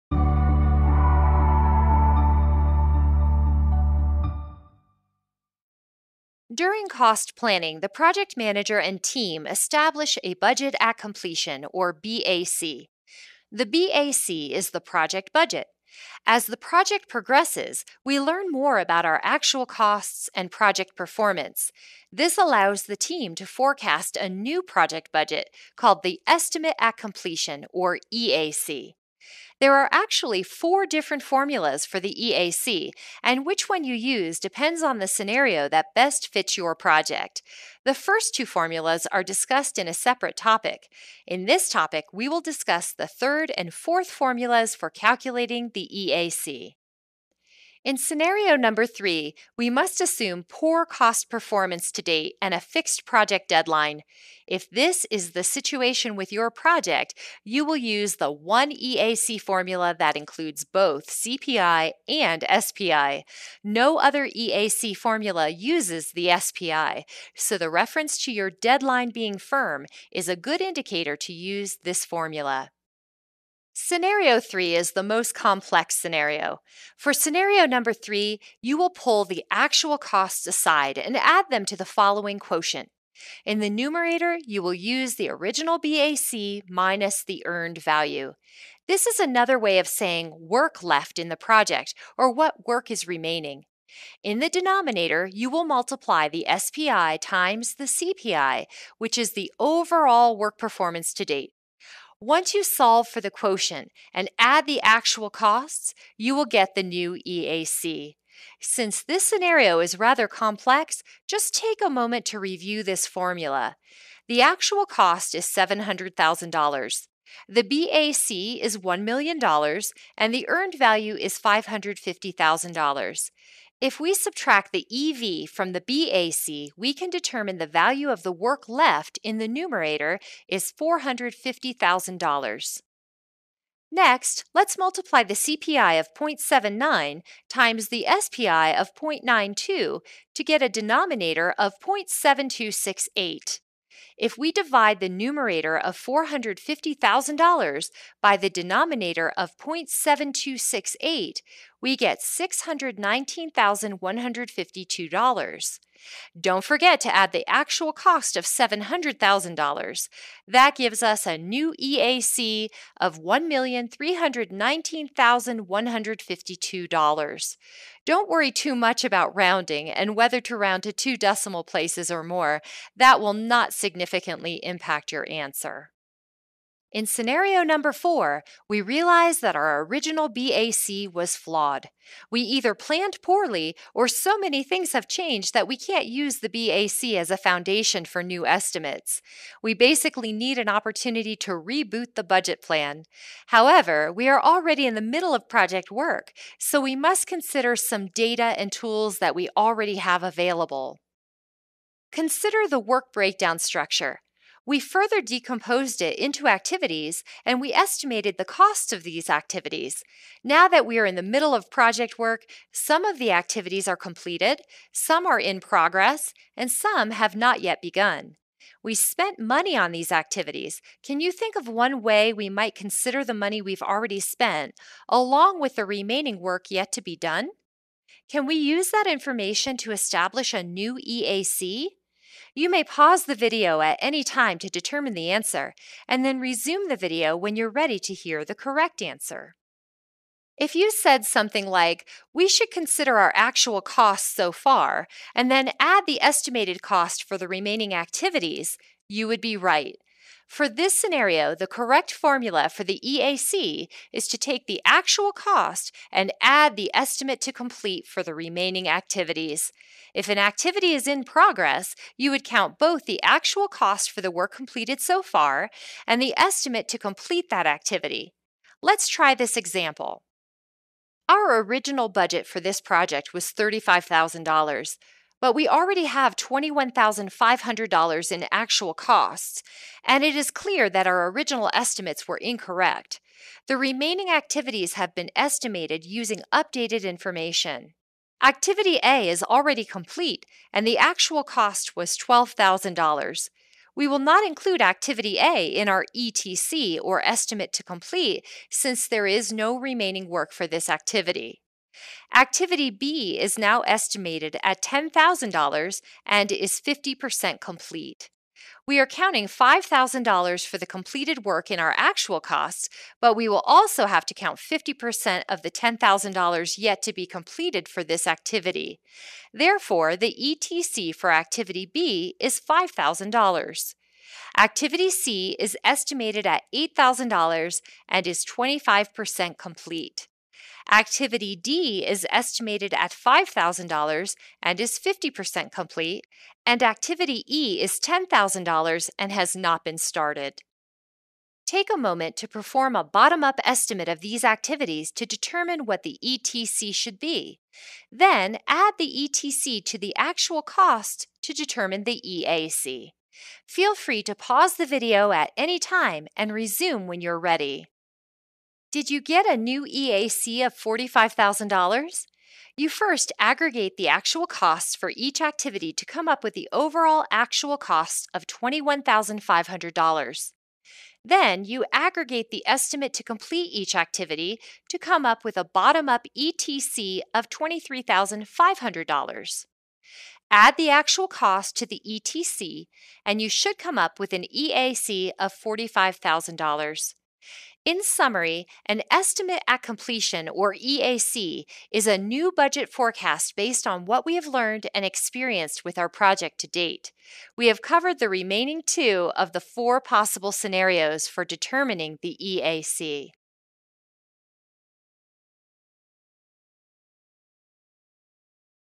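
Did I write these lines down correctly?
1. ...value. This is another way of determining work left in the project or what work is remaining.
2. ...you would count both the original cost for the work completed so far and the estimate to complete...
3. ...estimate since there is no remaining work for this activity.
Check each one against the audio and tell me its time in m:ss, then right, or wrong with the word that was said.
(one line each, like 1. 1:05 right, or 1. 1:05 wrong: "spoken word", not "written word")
1. 1:27 wrong: "saying", not "determining"
2. 4:22 wrong: "actual", not "original"
3. 4:57 wrong: "complete", not "estimate".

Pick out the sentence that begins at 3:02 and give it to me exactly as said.
We either planned poorly or so many things have changed that we can't use the BAC as a foundation for new estimates.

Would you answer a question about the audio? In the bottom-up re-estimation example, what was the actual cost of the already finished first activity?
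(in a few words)
$12,000.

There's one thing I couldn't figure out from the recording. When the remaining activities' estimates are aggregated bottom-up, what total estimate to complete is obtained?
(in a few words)
$23,500.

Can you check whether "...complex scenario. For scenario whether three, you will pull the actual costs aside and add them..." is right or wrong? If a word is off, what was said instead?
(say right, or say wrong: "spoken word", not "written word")
wrong: "number", not "whether".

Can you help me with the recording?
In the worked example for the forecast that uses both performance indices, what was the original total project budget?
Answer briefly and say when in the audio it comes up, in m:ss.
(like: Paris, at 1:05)
$1 million, at 1:58.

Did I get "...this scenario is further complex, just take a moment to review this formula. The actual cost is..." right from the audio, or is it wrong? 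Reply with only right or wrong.
wrong.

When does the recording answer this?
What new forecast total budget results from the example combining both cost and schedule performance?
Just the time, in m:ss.
2:43.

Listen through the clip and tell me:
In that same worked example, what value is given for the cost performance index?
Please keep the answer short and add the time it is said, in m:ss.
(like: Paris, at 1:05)
0.79, at 2:16.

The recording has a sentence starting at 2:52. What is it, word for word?
That will not significantly impact your answer.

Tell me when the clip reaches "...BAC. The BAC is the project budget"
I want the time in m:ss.
0:11.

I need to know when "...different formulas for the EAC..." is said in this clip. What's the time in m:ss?
0:30.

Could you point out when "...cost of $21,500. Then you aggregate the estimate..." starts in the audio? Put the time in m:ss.
6:07.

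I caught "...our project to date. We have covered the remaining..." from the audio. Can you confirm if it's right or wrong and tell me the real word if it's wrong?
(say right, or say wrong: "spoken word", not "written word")
right.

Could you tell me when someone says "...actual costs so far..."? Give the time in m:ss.
4:03.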